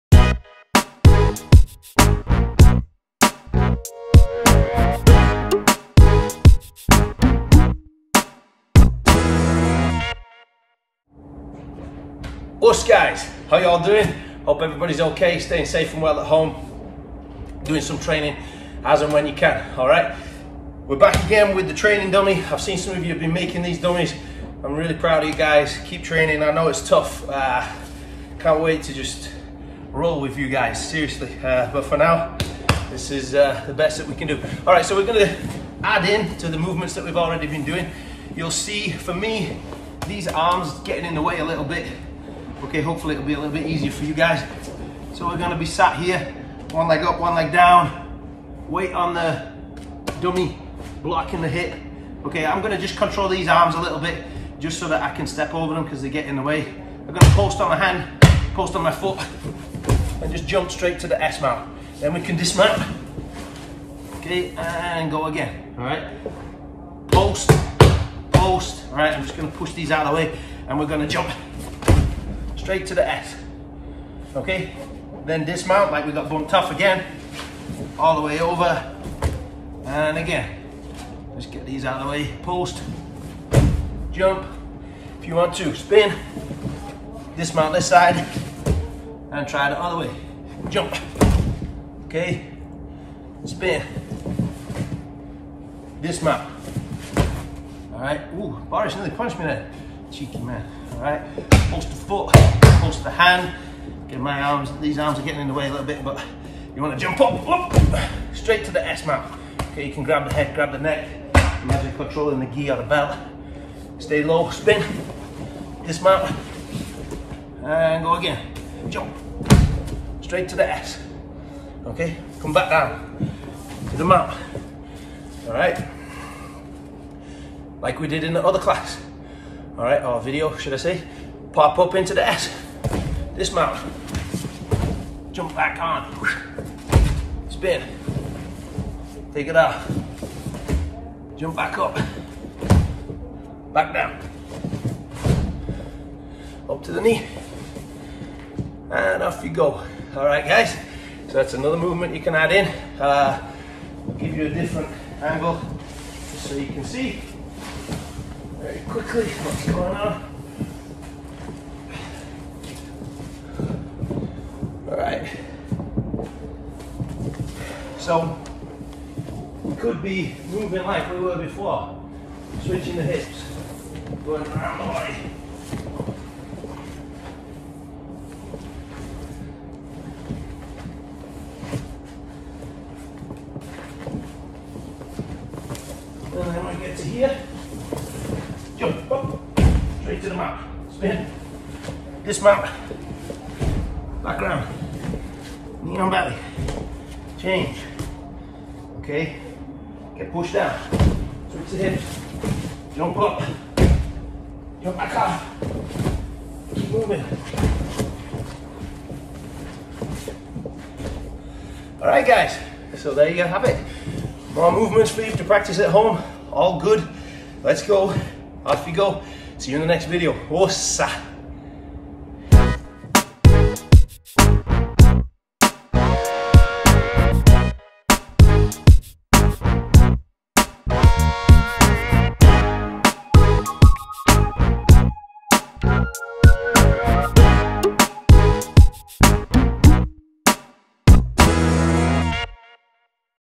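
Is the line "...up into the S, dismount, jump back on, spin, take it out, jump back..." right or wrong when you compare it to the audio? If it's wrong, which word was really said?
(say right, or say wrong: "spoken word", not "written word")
right.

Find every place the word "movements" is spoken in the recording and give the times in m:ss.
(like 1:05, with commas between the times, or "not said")
0:36, 2:31, 3:34.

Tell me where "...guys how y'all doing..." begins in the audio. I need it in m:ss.
0:12.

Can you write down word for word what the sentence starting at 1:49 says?
Okay, you can grab the head, grab the neck.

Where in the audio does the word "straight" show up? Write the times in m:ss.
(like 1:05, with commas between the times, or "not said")
1:00, 1:12, 1:48, 2:00.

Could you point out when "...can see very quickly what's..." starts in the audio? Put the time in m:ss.
2:36.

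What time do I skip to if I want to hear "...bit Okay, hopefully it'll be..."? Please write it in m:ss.
0:41.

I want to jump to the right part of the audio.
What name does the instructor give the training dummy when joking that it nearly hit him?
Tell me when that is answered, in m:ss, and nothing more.
1:38.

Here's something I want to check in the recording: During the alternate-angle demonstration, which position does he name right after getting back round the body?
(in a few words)
Knee on belly.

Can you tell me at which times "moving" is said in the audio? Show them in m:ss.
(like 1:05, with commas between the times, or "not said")
2:50, 3:26.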